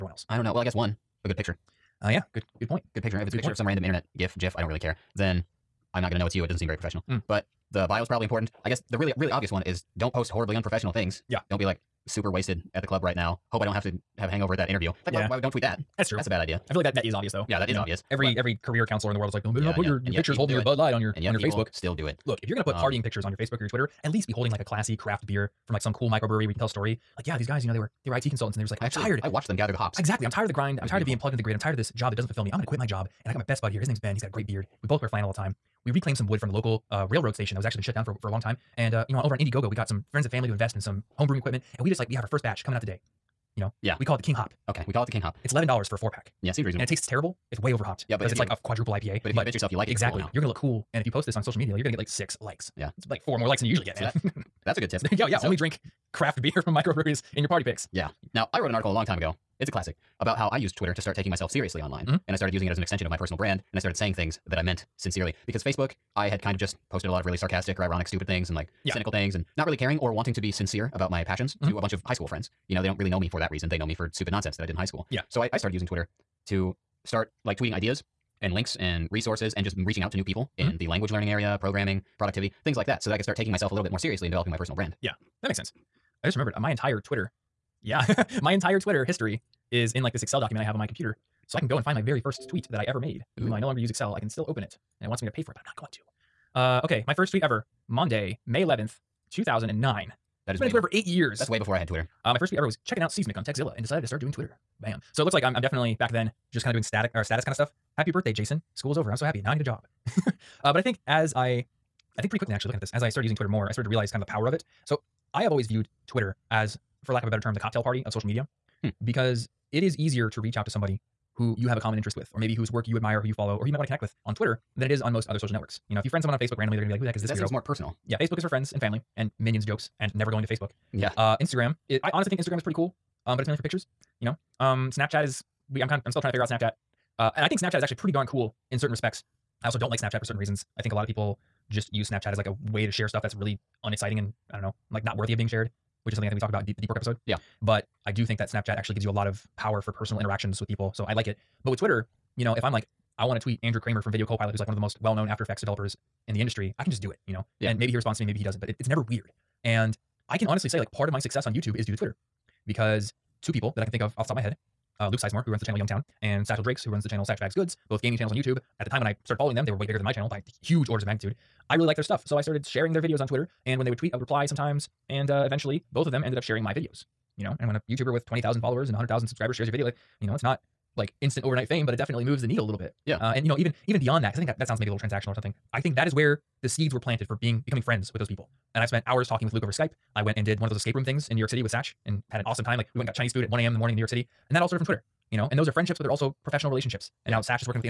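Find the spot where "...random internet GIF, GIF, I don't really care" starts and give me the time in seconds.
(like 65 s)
3 s.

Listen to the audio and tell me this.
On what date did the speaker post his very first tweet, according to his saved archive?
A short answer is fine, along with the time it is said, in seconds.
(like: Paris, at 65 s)
May 11th, 2009, at 98 s.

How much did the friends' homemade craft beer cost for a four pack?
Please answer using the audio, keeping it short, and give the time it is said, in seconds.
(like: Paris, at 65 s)
$11, at 45 s.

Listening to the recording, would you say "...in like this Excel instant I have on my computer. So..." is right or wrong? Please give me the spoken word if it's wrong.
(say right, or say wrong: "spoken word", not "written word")
wrong: "document", not "instant".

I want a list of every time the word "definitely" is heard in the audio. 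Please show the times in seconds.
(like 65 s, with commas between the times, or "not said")
105 s, 181 s.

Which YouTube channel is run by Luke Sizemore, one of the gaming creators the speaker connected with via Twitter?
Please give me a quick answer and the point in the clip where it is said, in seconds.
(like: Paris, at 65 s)
Youngtown, at 165 s.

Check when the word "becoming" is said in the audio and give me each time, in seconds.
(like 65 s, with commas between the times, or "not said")
187 s.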